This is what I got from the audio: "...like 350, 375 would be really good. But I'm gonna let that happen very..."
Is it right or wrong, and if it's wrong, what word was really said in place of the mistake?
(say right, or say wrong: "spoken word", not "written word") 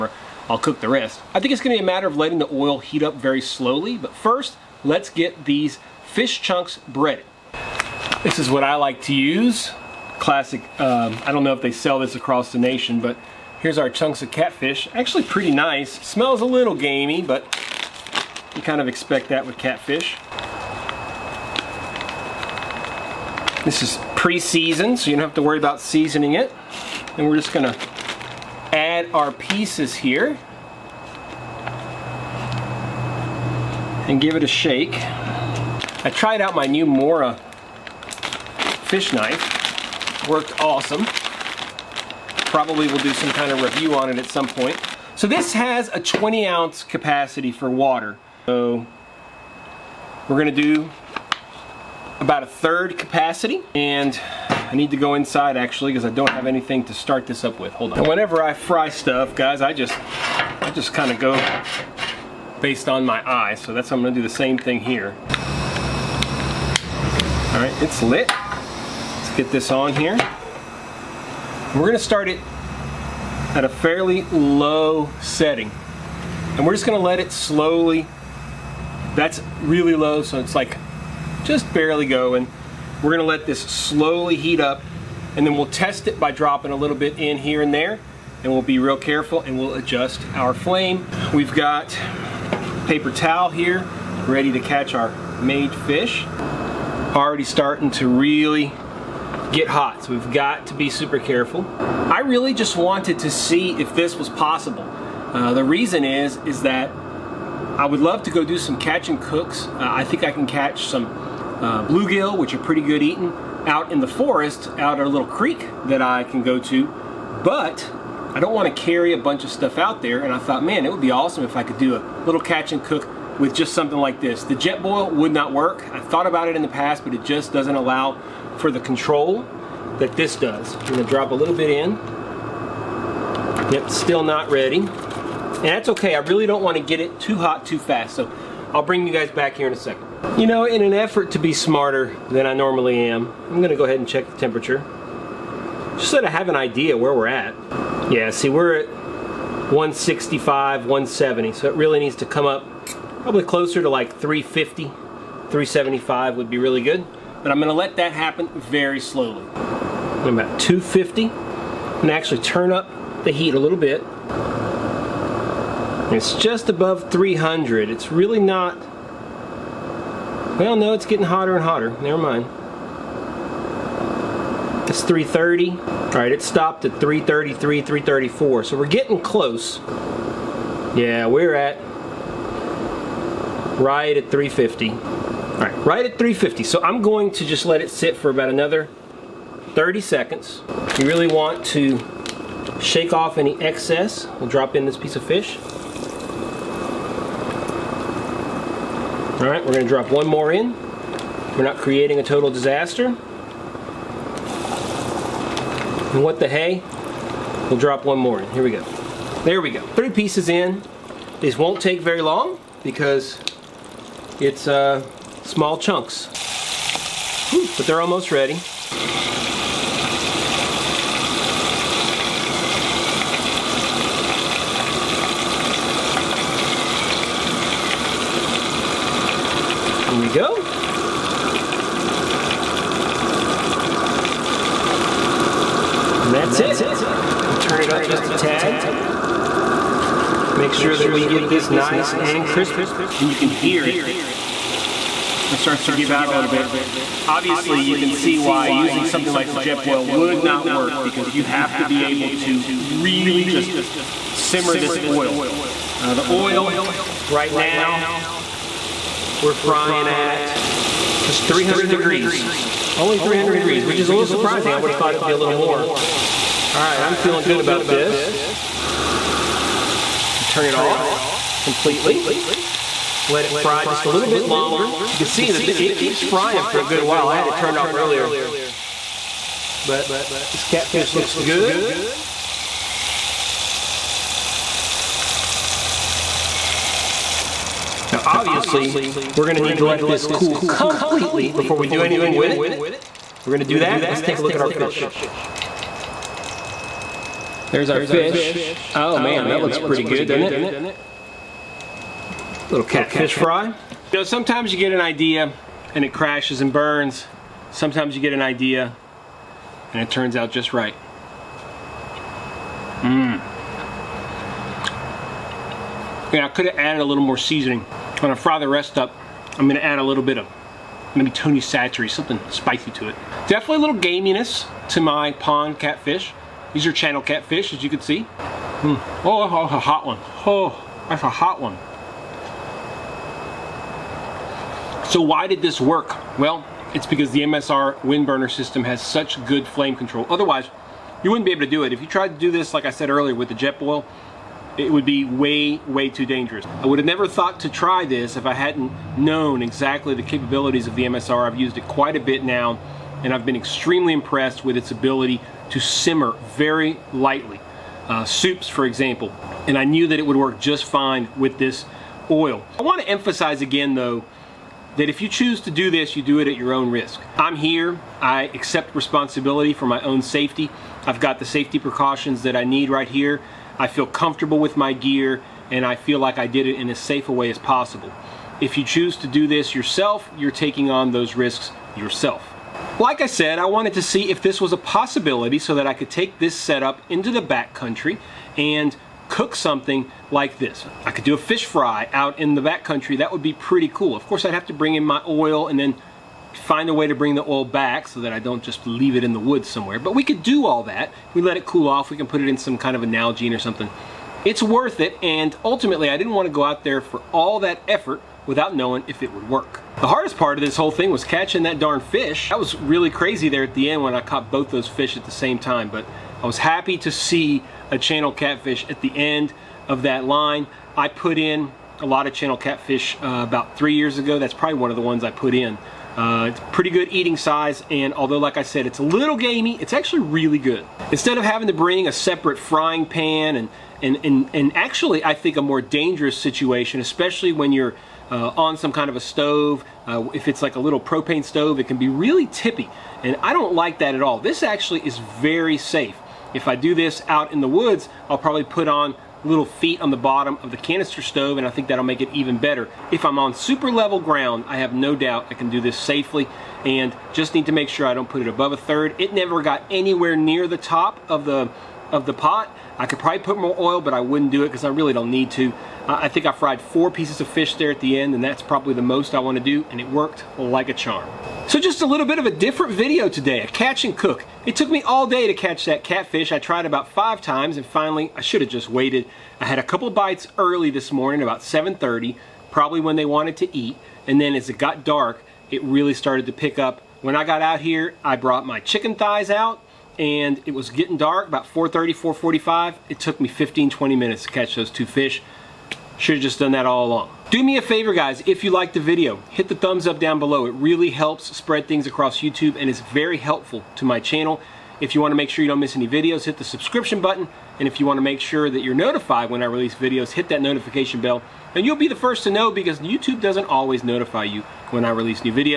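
right.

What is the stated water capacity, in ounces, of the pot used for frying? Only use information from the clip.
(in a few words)
20 ounces.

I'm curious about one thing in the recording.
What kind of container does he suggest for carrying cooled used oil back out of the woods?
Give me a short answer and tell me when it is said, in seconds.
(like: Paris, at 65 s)
Nalgene, at 403 s.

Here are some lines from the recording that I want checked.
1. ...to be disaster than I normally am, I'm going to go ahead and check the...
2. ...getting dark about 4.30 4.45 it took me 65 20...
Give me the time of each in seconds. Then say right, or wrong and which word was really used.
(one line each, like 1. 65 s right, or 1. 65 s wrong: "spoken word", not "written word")
1. 141 s wrong: "smarter", not "disaster"
2. 490 s wrong: "15", not "65".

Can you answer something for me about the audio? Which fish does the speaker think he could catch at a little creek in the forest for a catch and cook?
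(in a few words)
Bluegill.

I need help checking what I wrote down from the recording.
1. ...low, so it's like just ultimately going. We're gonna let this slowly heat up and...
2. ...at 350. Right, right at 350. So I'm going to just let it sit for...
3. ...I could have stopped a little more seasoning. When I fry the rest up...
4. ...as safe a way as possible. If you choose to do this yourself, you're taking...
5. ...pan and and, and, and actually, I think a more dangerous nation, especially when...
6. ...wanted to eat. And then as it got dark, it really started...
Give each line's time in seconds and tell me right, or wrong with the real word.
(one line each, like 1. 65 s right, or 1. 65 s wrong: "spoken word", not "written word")
1. 79 s wrong: "barely", not "ultimately"
2. 184 s right
3. 316 s wrong: "added", not "stopped"
4. 376 s right
5. 433 s wrong: "situation", not "nation"
6. 483 s right.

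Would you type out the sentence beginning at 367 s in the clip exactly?
I'm here, I accept responsibility for my own safety.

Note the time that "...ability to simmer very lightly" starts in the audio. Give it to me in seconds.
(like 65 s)
354 s.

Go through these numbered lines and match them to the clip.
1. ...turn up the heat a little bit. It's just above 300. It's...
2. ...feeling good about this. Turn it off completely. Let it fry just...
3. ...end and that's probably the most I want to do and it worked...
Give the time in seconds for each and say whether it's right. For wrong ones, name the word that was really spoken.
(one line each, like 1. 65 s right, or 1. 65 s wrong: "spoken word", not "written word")
1. 162 s right
2. 267 s right
3. 468 s right.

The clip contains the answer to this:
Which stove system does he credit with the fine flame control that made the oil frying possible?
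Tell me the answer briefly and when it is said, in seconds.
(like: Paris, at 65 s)
MSR Windburner, at 337 s.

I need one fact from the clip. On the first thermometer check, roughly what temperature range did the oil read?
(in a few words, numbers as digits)
165 to 170.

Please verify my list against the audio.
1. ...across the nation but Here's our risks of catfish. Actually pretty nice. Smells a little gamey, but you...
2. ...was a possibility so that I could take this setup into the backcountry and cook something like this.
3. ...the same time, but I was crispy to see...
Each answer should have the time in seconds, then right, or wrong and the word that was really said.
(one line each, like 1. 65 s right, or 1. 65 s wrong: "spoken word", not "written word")
1. 12 s wrong: "chunks", not "risks"
2. 384 s right
3. 415 s wrong: "happy", not "crispy".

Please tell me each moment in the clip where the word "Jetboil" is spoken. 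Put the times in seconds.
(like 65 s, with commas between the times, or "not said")
124 s, 249 s, 343 s.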